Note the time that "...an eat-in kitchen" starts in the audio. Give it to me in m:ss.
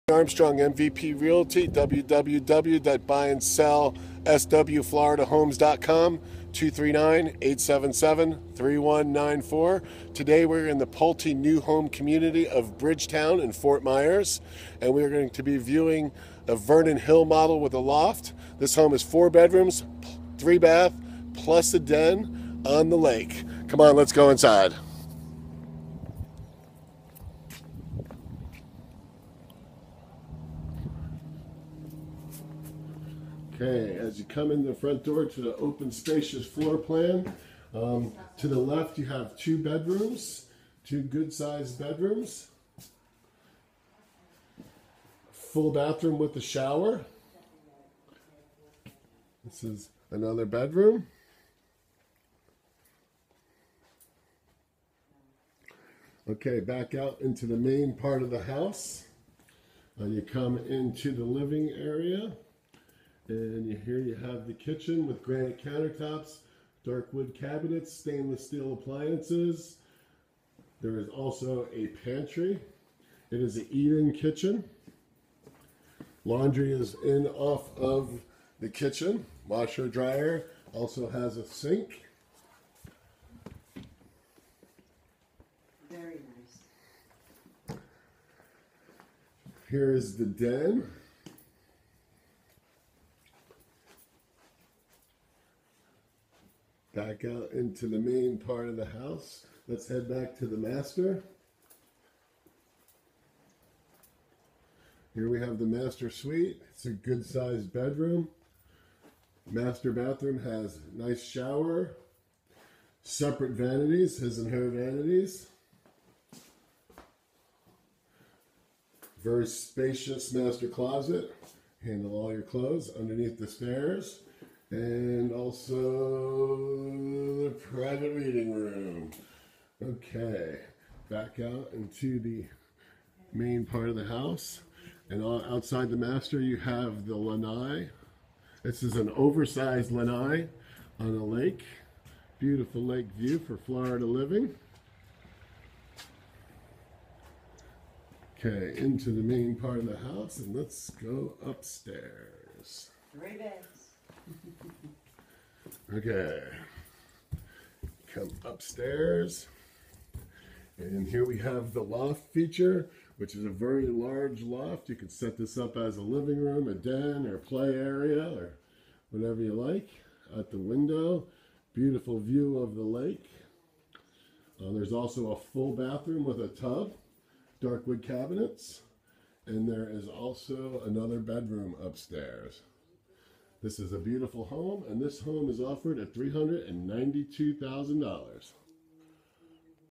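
1:13.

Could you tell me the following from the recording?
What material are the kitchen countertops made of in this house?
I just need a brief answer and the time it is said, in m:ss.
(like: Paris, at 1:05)
Granite, at 1:05.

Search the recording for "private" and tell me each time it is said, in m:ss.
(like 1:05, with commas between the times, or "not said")
2:07.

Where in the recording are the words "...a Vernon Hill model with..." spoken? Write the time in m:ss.
0:16.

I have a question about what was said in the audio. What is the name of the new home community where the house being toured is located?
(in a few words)
Bridgetown.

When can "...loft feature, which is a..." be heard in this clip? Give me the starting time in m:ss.
2:41.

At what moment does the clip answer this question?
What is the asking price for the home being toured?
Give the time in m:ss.
3:06.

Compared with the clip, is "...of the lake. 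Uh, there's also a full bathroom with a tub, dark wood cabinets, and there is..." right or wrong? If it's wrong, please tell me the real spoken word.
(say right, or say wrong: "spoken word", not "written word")
right.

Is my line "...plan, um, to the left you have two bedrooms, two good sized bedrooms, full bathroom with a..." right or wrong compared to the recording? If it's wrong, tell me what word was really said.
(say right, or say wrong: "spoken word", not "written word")
right.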